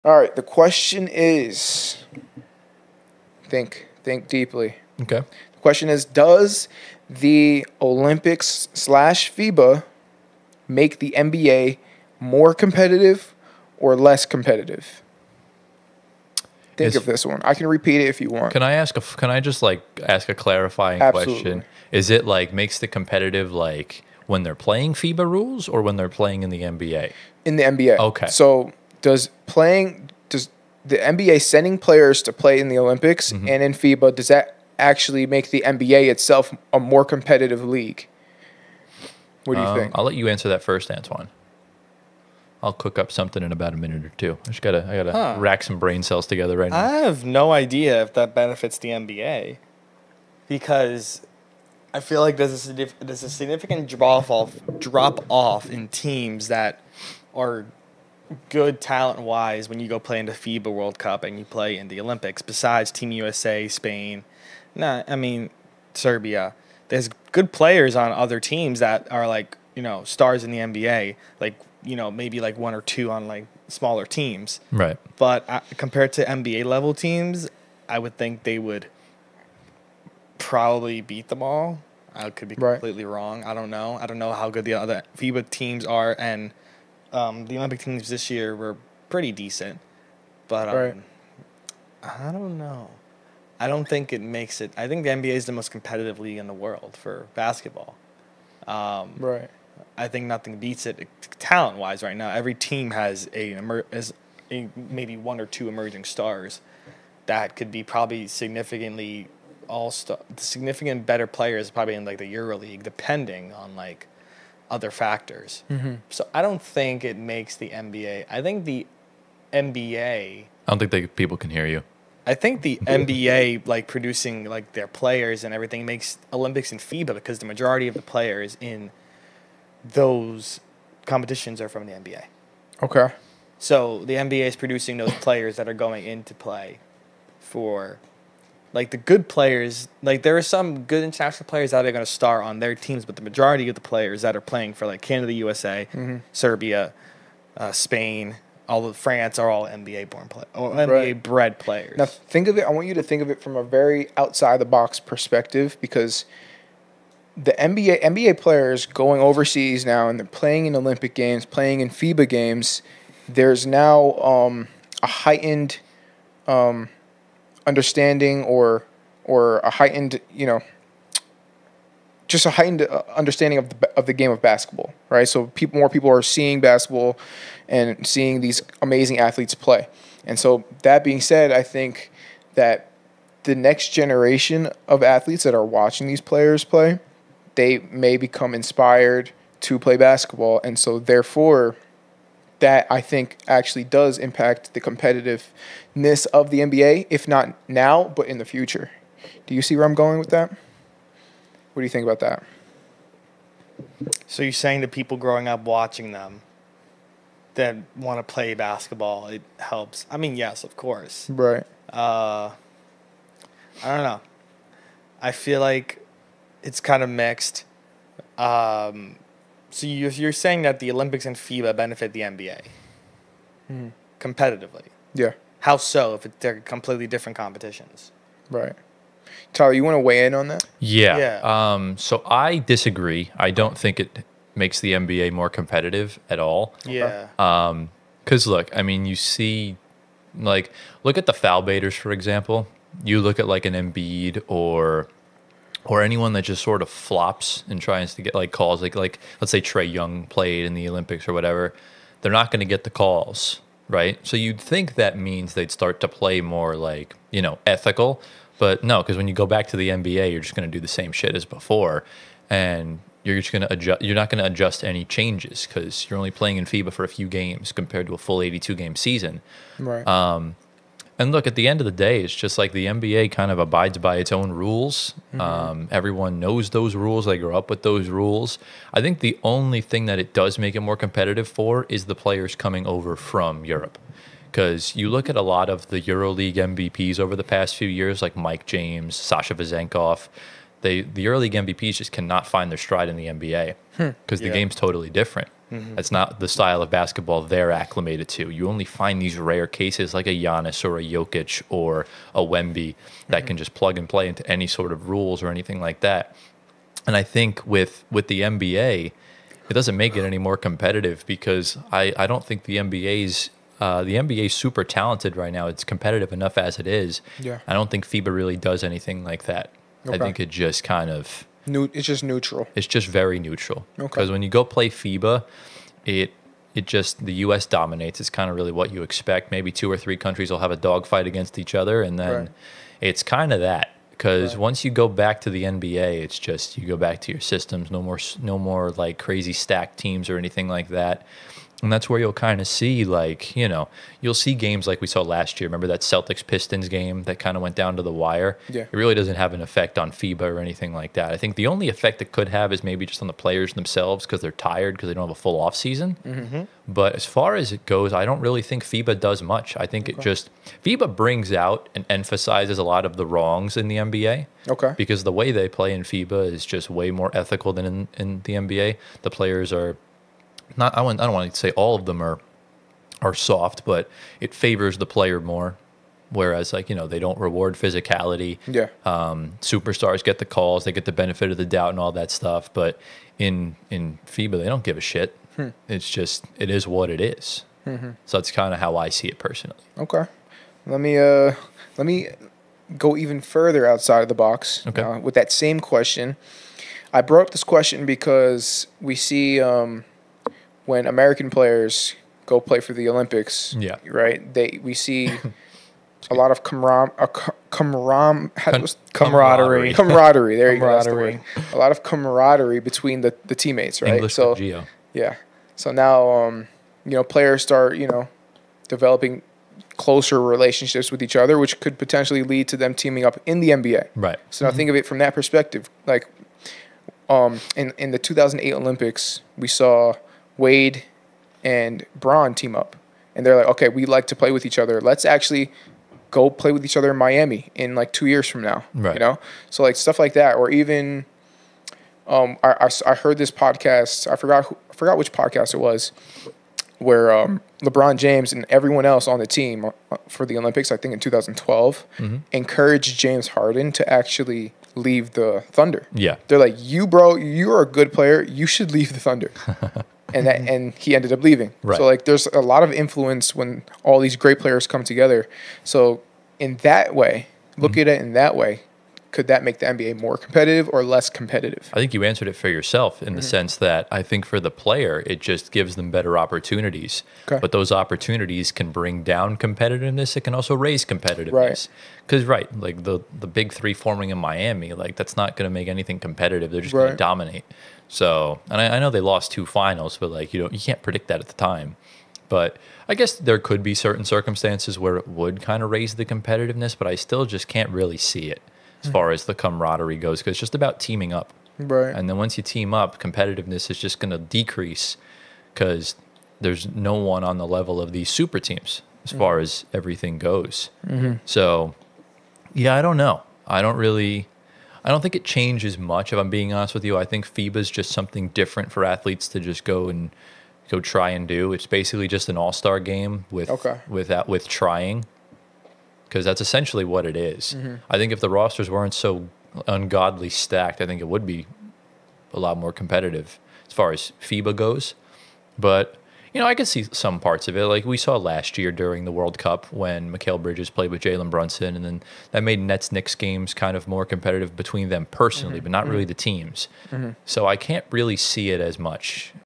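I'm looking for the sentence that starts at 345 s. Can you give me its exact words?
Remember that Celtics Pistons game that kind of went down to the wire?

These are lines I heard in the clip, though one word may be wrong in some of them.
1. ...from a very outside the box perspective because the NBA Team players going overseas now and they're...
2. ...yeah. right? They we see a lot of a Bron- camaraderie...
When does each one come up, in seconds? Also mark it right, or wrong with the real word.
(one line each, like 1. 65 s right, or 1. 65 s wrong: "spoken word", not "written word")
1. 153 s wrong: "NBA", not "Team"
2. 403 s wrong: "Con", not "Bron".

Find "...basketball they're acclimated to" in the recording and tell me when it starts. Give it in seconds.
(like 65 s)
296 s.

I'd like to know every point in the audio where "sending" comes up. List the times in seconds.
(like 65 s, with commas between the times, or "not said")
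31 s.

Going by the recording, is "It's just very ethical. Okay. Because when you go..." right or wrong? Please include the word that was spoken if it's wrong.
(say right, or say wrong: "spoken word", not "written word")
wrong: "neutral", not "ethical".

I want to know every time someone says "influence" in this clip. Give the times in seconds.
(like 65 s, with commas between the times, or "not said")
462 s.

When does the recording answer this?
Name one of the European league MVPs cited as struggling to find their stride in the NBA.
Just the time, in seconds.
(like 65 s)
288 s.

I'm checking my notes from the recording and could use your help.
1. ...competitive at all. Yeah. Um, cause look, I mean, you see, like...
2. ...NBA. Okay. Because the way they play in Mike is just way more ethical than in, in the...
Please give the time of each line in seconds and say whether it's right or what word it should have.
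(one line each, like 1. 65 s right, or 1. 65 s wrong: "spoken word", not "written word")
1. 235 s right
2. 363 s wrong: "FIBA", not "Mike".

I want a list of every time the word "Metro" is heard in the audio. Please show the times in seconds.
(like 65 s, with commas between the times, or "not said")
not said.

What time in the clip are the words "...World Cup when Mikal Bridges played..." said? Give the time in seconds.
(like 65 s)
539 s.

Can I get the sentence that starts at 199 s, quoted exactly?
Do you see where I'm going with that?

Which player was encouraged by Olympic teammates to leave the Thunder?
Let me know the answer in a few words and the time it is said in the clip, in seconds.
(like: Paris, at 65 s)
James Harden, at 453 s.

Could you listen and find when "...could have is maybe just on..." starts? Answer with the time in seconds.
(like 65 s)
352 s.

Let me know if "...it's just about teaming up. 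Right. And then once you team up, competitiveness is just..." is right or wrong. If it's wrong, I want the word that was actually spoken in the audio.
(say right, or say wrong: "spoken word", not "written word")
right.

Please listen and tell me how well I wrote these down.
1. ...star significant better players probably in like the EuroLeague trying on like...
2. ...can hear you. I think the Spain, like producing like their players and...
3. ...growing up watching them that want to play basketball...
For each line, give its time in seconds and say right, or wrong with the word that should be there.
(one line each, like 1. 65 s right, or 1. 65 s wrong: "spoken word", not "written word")
1. 109 s wrong: "depending", not "trying"
2. 121 s wrong: "NBA", not "Spain"
3. 205 s right.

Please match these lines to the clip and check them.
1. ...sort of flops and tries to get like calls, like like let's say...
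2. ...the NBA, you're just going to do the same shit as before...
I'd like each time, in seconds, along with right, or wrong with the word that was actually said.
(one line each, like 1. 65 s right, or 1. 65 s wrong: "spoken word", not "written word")
1. 246 s right
2. 259 s right.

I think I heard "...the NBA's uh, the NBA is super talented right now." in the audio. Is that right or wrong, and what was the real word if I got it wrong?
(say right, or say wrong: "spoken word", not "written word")
right.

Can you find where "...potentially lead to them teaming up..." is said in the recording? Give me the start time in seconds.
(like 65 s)
421 s.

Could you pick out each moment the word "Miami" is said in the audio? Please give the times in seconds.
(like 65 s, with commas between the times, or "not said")
437 s, 484 s.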